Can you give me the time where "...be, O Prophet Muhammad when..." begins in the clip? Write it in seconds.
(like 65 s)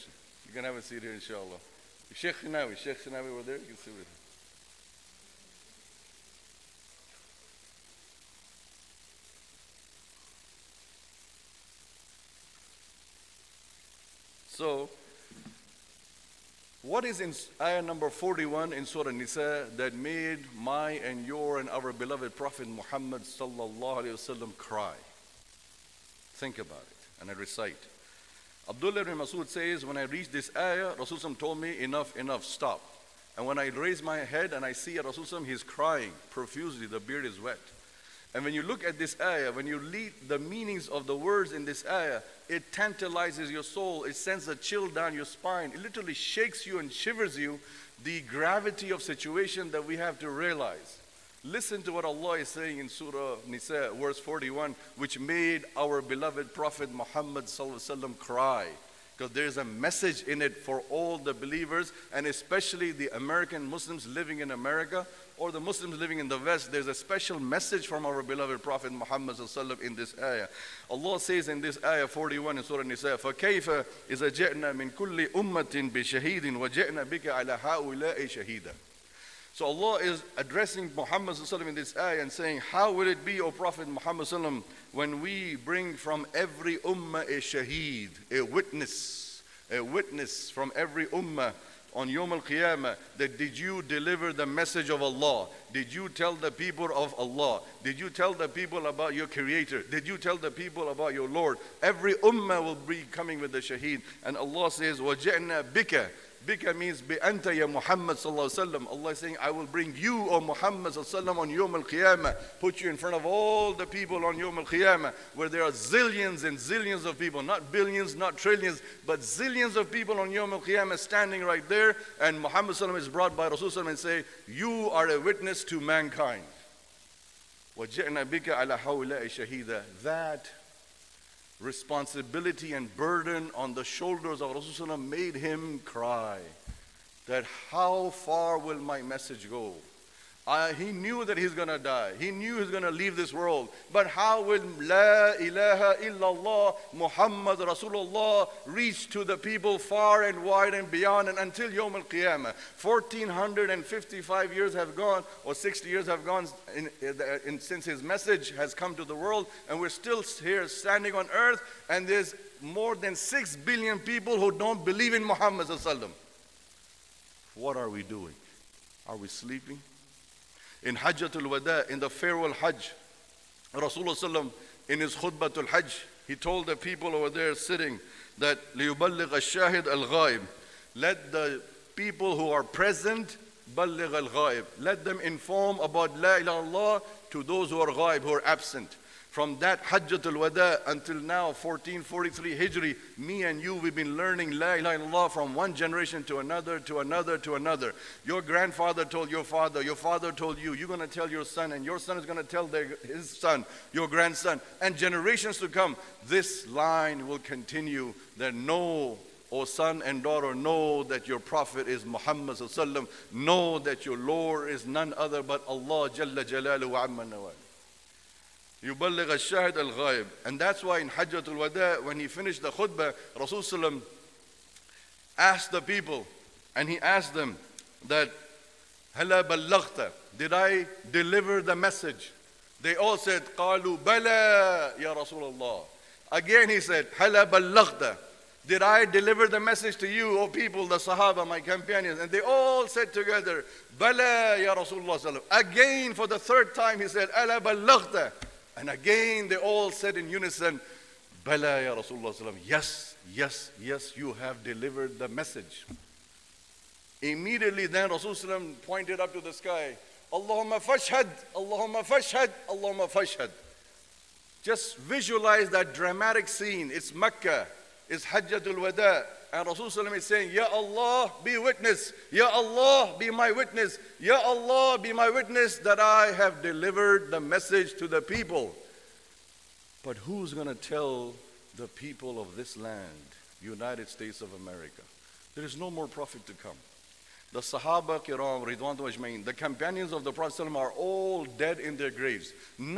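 83 s.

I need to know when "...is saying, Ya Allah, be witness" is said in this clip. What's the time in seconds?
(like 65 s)
270 s.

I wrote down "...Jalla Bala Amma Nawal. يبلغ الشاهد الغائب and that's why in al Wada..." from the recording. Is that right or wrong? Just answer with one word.
wrong.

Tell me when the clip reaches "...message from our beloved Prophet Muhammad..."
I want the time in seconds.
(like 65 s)
67 s.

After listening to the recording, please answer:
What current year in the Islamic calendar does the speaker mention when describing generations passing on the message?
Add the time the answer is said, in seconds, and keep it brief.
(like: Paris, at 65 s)
1443 Hijri, at 191 s.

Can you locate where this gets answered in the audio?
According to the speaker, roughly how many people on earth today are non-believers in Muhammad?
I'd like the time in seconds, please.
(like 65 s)
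162 s.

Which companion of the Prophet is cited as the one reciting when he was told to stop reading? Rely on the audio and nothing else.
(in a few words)
Abdullah ibn Masud.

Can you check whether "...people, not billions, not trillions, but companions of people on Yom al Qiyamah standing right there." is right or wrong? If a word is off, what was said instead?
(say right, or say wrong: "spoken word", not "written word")
wrong: "zillions", not "companions".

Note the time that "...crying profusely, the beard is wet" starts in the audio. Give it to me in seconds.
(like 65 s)
35 s.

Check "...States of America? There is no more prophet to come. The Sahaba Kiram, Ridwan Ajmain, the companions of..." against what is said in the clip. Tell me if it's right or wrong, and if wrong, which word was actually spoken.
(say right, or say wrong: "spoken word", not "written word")
right.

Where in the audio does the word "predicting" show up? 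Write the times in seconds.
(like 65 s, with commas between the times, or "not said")
not said.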